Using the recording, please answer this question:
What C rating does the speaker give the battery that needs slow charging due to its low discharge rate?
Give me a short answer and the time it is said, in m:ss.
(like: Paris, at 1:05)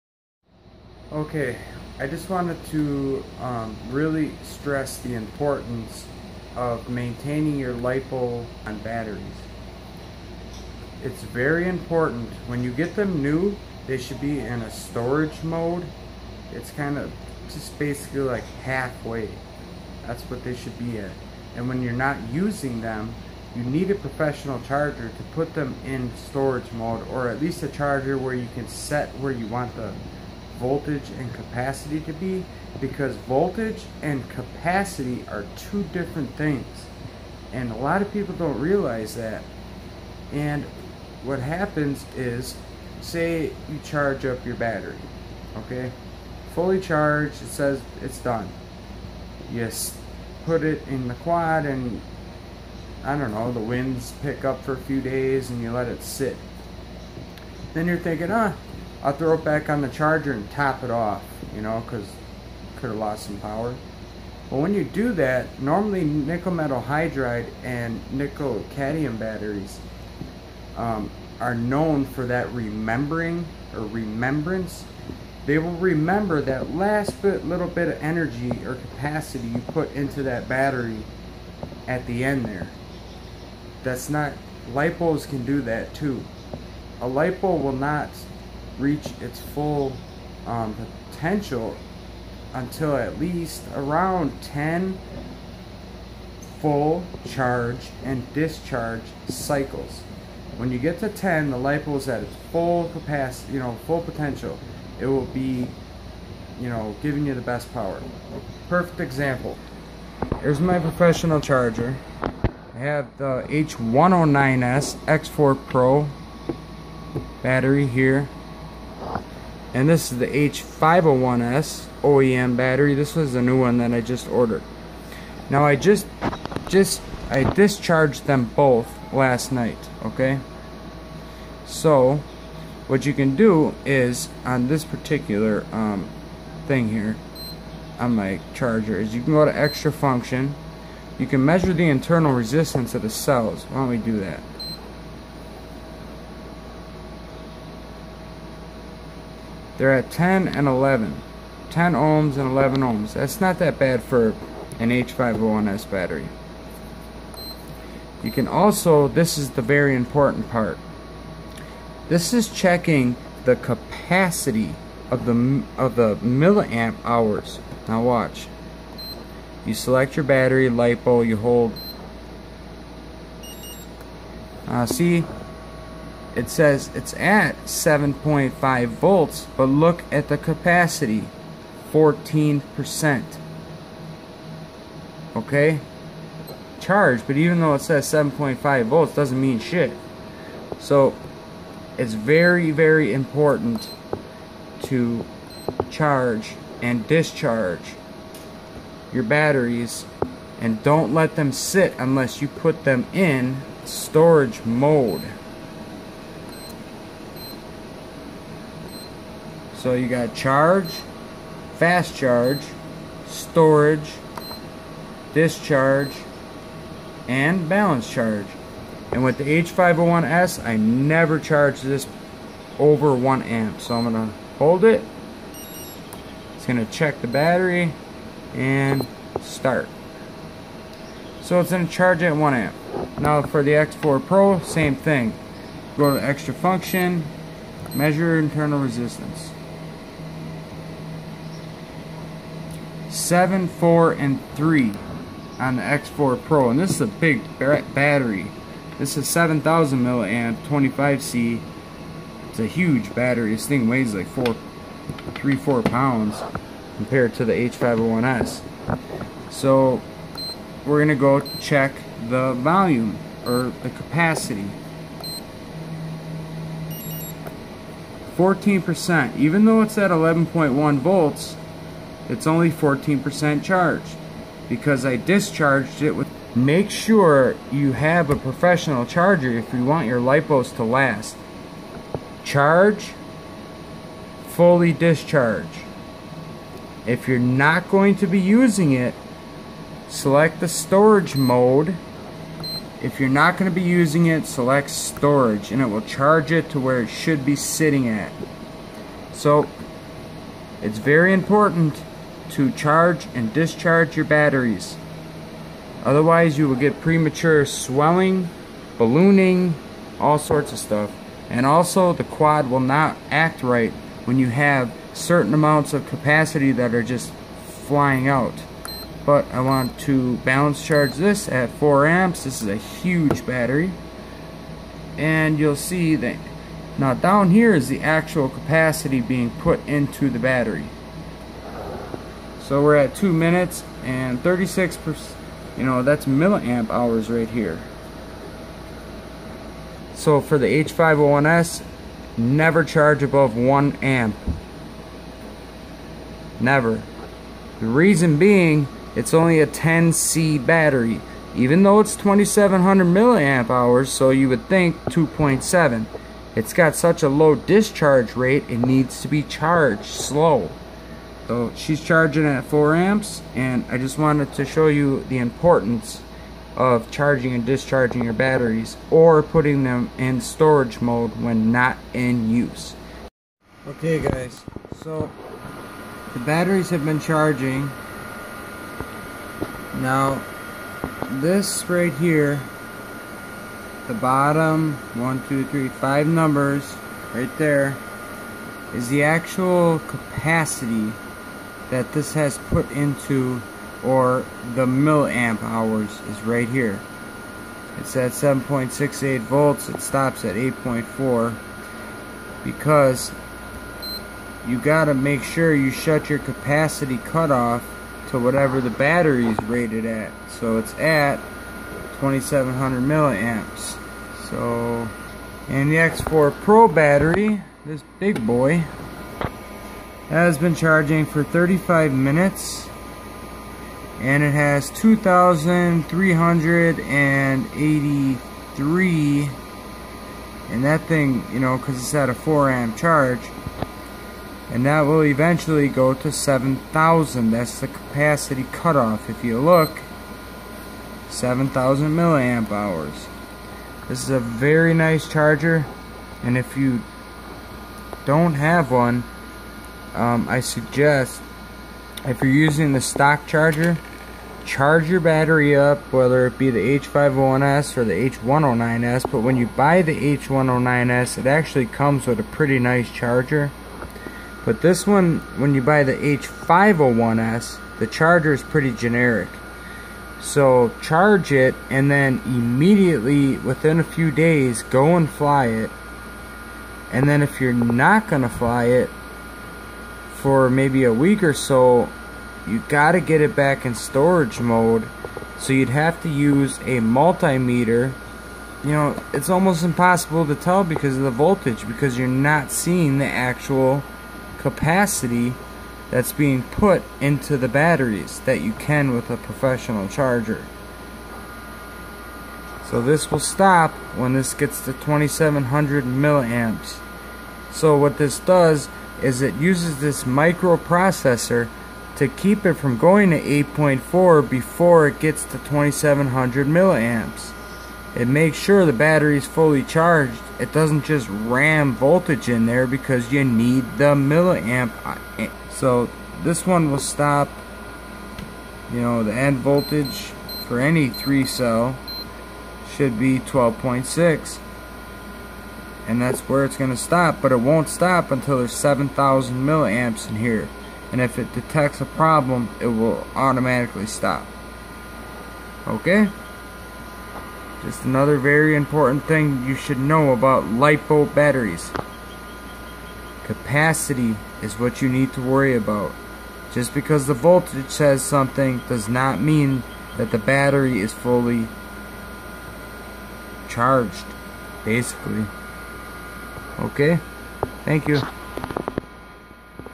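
10C, at 5:49.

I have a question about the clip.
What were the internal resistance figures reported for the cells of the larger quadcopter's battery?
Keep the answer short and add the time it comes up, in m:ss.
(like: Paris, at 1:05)
7, 4, and 3, at 4:03.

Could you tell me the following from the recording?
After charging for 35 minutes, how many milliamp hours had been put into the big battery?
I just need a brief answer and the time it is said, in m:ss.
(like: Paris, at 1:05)
2,383, at 7:04.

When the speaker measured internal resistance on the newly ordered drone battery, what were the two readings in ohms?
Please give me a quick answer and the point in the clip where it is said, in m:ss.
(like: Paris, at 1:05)
10 and 11, at 2:30.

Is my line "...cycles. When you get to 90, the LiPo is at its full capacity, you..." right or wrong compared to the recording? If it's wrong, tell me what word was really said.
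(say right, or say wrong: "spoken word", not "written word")
wrong: "10", not "90".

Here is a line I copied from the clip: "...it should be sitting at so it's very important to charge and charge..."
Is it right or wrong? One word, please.
wrong.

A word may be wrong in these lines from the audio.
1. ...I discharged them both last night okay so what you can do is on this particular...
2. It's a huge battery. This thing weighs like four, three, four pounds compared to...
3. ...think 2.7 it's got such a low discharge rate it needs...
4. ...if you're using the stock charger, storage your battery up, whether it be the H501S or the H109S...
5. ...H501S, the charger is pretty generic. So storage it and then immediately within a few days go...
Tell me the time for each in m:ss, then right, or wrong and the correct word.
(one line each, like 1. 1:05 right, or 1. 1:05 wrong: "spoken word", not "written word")
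1. 2:07 right
2. 4:12 right
3. 5:54 right
4. 7:32 wrong: "charge", not "storage"
5. 7:46 wrong: "charge", not "storage".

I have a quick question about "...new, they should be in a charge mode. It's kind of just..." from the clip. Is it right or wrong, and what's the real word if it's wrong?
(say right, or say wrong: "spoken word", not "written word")
wrong: "storage", not "charge".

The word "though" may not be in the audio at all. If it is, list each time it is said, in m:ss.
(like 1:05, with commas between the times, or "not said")
3:07, 4:29, 5:51.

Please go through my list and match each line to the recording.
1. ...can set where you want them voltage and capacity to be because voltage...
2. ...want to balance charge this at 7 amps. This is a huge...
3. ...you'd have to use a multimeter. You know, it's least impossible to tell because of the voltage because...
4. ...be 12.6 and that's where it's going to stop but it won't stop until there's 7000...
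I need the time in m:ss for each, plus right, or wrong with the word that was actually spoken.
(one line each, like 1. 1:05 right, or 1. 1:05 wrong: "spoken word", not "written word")
1. 0:28 right
2. 5:19 wrong: "4", not "7"
3. 8:05 wrong: "almost", not "least"
4. 8:53 right.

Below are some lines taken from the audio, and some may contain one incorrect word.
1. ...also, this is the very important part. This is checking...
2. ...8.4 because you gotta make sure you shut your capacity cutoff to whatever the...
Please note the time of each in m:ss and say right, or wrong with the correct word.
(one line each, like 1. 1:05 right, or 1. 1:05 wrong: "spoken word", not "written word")
1. 2:38 right
2. 6:40 right.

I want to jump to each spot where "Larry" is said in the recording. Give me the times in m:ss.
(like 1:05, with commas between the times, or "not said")
not said.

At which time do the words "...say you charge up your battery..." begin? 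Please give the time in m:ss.
0:43.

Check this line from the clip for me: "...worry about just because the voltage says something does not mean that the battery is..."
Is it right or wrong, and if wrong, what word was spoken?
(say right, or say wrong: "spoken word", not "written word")
right.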